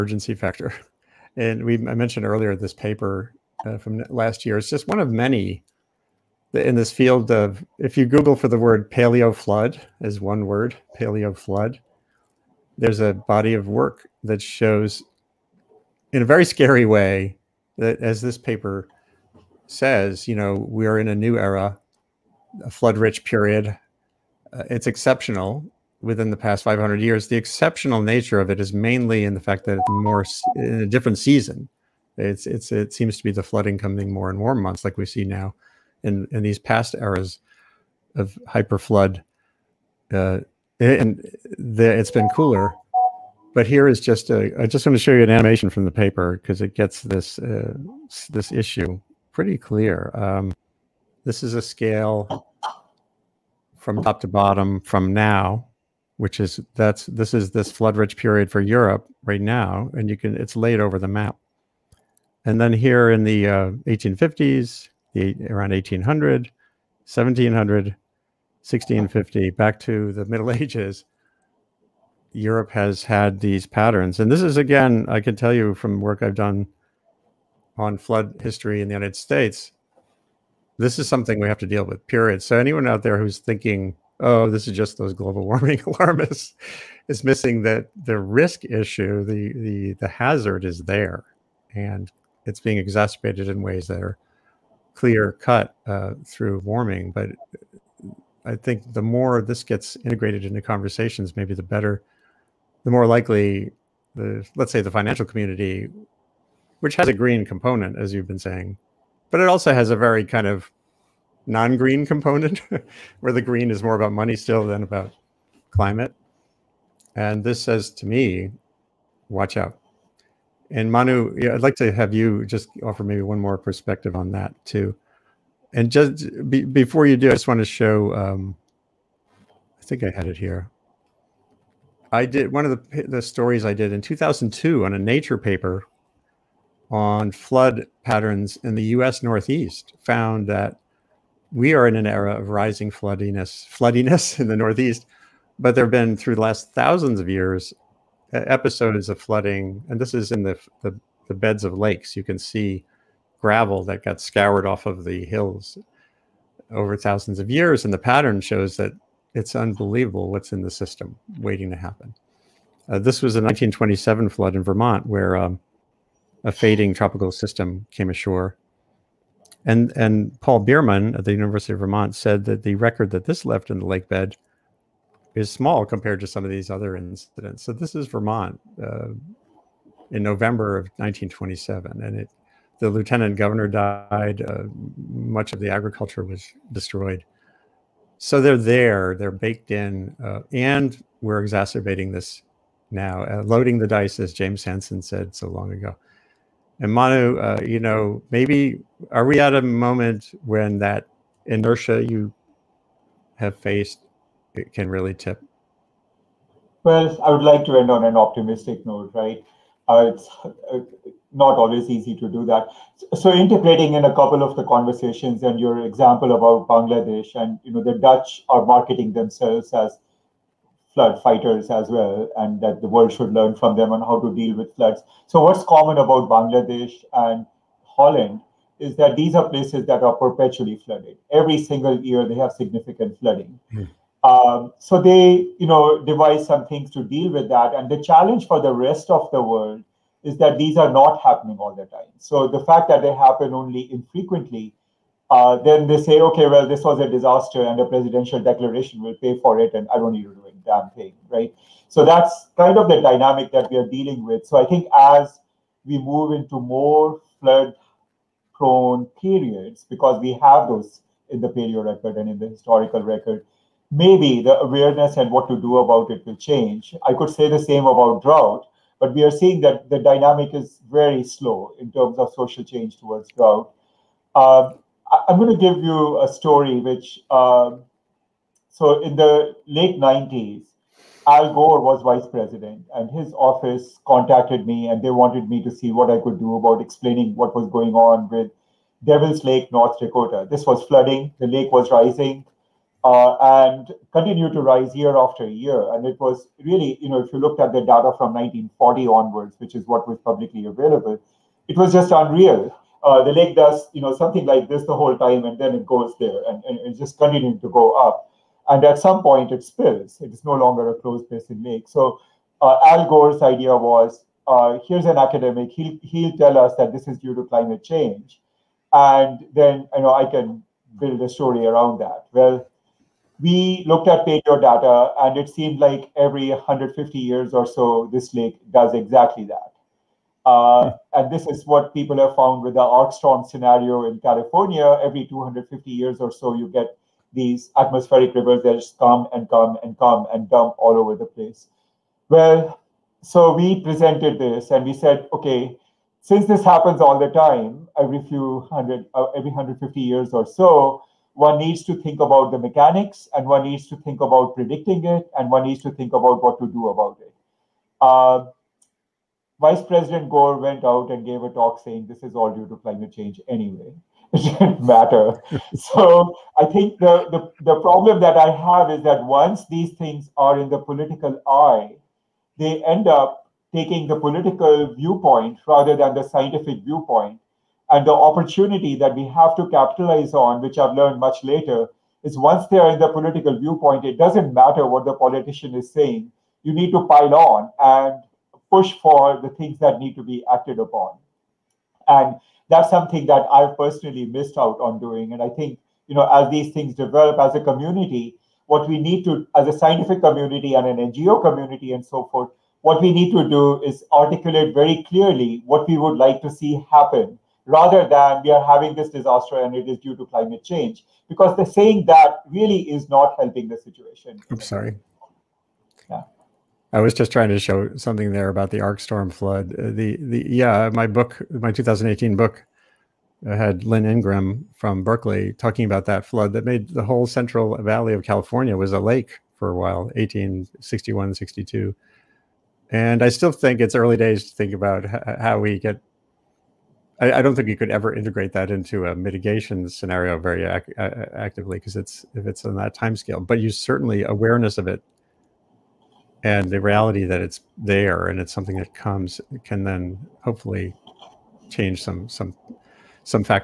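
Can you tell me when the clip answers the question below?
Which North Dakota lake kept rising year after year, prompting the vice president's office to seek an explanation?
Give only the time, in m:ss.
4:49.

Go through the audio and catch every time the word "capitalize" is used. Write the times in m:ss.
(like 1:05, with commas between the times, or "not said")
6:19.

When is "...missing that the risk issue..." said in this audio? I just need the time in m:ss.
1:27.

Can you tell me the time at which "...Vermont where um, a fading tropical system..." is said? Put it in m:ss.
2:44.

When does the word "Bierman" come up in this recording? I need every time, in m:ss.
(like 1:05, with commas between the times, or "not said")
2:50.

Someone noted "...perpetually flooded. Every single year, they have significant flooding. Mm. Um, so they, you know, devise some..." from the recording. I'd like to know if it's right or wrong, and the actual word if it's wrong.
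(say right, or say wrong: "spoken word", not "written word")
right.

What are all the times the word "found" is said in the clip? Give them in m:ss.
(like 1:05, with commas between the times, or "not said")
2:19, 5:32.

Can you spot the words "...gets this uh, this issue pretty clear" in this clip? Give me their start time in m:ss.
0:46.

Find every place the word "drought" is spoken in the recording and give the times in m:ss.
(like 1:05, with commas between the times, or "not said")
4:28, 4:33.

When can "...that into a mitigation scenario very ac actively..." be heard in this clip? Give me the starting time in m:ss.
7:18.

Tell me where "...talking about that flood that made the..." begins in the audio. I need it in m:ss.
7:05.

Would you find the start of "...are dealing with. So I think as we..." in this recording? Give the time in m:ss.
4:13.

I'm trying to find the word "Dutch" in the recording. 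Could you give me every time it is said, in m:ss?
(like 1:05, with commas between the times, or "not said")
3:37.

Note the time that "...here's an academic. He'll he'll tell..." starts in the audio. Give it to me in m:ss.
5:14.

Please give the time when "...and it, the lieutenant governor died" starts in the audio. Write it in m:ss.
3:02.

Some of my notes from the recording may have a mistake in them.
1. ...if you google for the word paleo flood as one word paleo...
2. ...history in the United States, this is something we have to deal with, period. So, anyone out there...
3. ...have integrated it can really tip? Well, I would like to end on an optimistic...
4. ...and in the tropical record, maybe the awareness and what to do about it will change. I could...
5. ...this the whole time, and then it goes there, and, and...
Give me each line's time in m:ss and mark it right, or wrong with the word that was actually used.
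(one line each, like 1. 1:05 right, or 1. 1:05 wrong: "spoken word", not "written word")
1. 0:07 right
2. 1:18 right
3. 3:23 wrong: "faced", not "integrated"
4. 4:22 wrong: "historical", not "tropical"
5. 5:04 right.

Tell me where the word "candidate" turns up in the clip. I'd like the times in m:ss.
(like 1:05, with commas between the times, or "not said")
not said.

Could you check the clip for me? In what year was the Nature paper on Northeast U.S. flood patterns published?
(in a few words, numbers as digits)
2002.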